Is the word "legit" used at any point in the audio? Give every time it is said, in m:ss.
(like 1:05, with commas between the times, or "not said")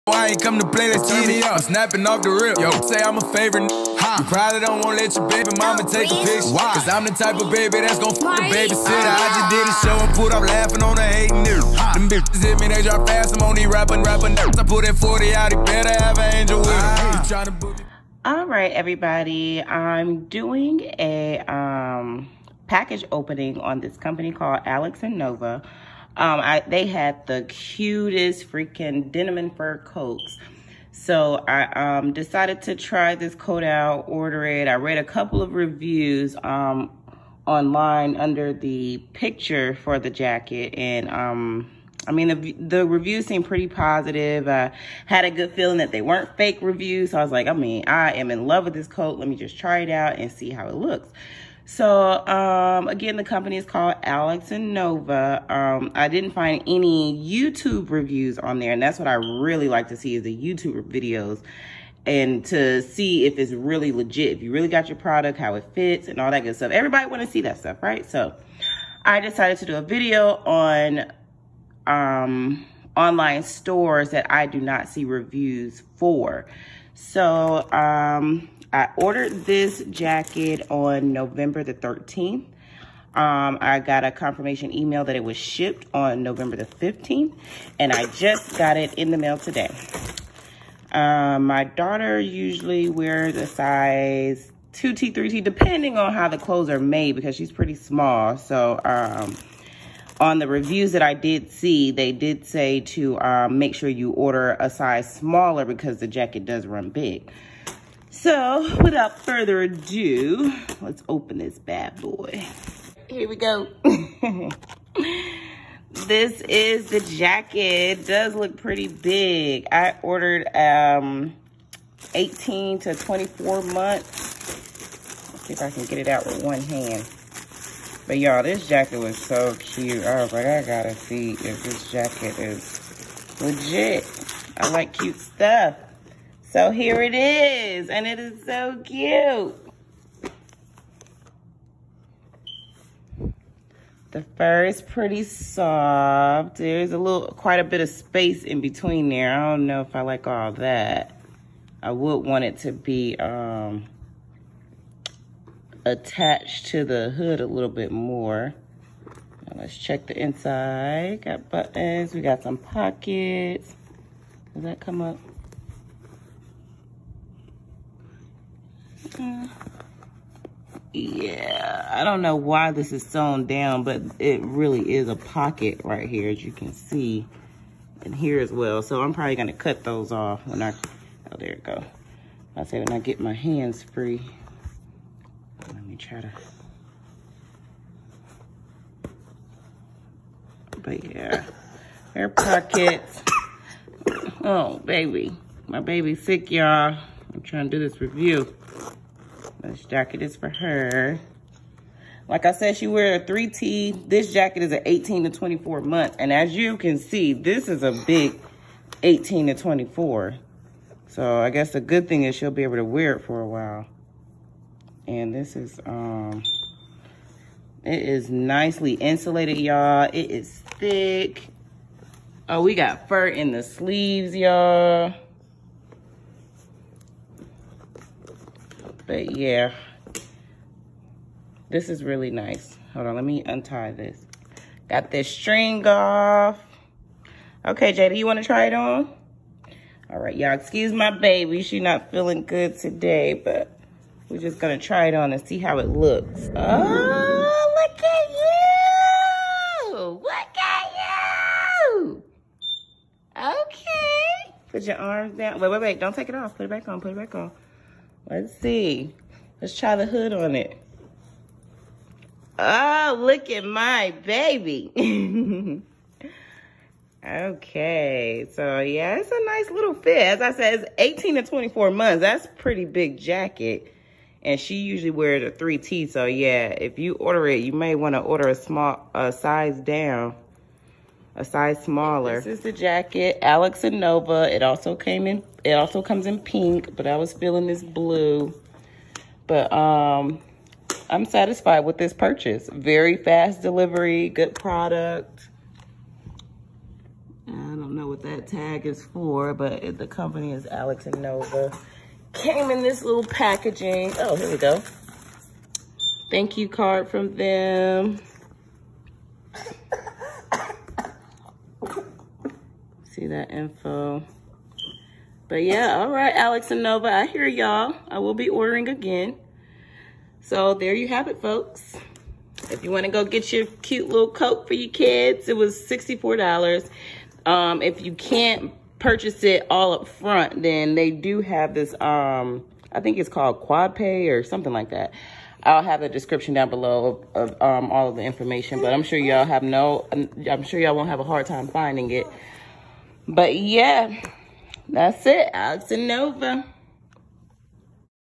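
1:03, 2:13.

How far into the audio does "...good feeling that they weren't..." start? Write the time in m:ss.
0:45.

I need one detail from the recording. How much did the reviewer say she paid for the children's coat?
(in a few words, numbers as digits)
$64.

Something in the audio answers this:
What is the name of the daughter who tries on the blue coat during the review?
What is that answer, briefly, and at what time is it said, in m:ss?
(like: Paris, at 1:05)
Jada, at 3:57.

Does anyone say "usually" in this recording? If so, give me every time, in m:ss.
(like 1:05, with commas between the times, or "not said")
1:32, 4:34.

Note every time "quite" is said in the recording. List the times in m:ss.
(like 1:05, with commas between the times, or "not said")
2:27.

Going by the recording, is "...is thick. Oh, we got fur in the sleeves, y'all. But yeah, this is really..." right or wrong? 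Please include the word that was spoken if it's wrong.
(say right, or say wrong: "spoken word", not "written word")
right.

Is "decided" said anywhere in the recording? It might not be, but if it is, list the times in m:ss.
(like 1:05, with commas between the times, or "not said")
0:32, 1:09.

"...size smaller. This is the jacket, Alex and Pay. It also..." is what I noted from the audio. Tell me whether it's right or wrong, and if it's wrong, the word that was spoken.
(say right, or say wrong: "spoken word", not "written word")
wrong: "Nova", not "Pay".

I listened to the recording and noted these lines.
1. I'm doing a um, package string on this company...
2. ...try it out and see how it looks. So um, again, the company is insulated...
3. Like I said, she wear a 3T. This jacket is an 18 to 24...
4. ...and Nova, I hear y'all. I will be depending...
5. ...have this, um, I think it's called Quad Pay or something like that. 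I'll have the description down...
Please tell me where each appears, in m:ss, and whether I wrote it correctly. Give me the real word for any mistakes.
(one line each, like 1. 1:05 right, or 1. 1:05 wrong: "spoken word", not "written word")
1. 0:19 wrong: "opening", not "string"
2. 0:49 wrong: "called", not "insulated"
3. 3:22 right
4. 5:16 wrong: "ordering", not "depending"
5. 5:31 right.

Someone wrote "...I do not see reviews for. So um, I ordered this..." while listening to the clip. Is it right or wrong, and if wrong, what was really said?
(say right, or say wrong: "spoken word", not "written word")
right.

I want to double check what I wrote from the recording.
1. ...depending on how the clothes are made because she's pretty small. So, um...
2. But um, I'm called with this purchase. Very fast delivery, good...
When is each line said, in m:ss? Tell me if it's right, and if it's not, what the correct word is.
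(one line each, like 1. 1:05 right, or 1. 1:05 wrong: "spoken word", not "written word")
1. 1:35 right
2. 4:49 wrong: "satisfied", not "called".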